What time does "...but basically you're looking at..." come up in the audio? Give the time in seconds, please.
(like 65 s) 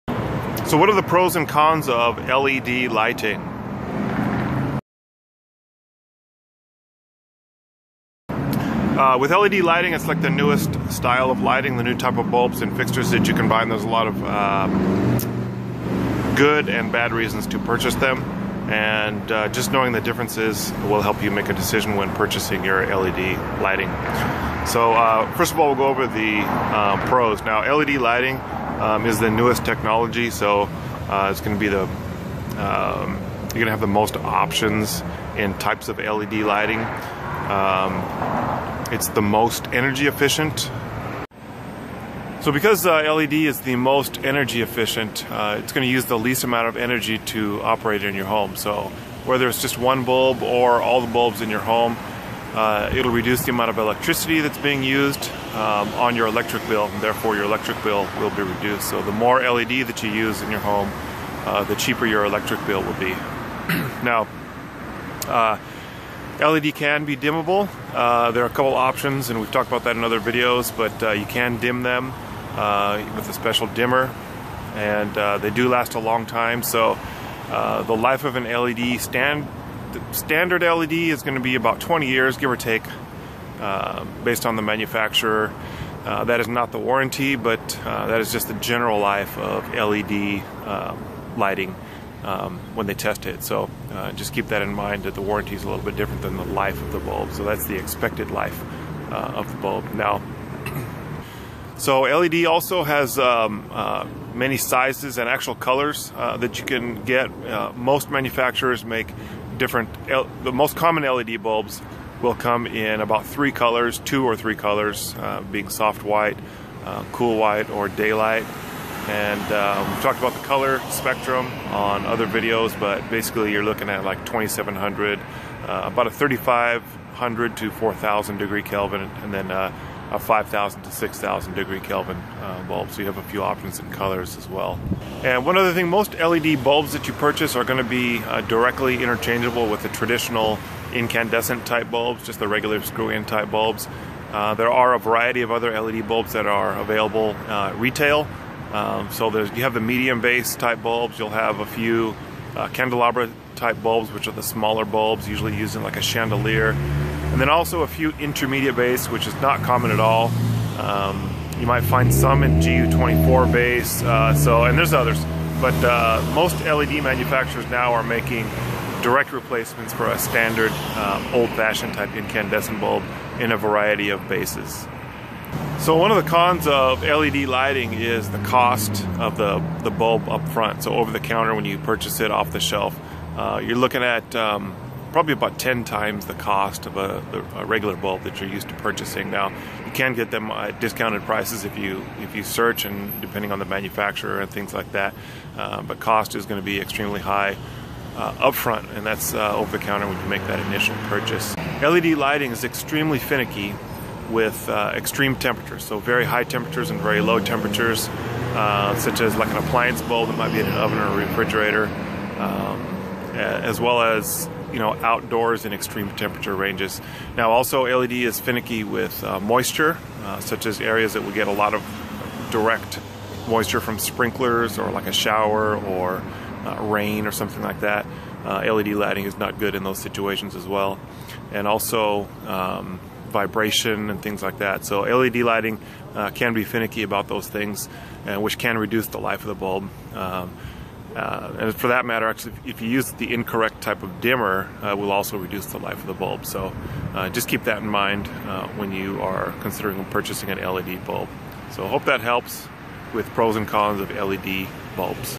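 122 s.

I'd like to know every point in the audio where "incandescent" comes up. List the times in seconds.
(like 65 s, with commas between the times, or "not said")
140 s, 172 s.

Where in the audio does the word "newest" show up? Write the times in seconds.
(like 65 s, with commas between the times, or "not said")
10 s, 29 s.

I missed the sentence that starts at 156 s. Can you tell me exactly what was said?
And then also a few intermediate base, which is not common at all.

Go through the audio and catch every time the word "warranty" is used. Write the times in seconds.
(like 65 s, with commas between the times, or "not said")
86 s, 95 s.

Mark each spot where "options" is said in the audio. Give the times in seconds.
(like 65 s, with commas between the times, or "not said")
34 s, 68 s, 133 s.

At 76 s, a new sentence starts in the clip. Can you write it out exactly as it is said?
So the life of an LED stand standard LED is going to be about 20 years, give or take.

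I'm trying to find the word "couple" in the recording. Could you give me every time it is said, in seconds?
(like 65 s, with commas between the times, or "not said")
68 s.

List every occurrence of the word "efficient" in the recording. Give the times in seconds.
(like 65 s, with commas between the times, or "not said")
40 s, 44 s.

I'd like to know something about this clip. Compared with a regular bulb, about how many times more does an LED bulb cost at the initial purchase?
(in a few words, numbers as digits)
10 times.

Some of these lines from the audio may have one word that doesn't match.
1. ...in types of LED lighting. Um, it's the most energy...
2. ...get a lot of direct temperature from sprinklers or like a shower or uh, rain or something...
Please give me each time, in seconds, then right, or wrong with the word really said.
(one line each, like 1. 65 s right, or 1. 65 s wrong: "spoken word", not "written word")
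1. 35 s right
2. 221 s wrong: "moisture", not "temperature".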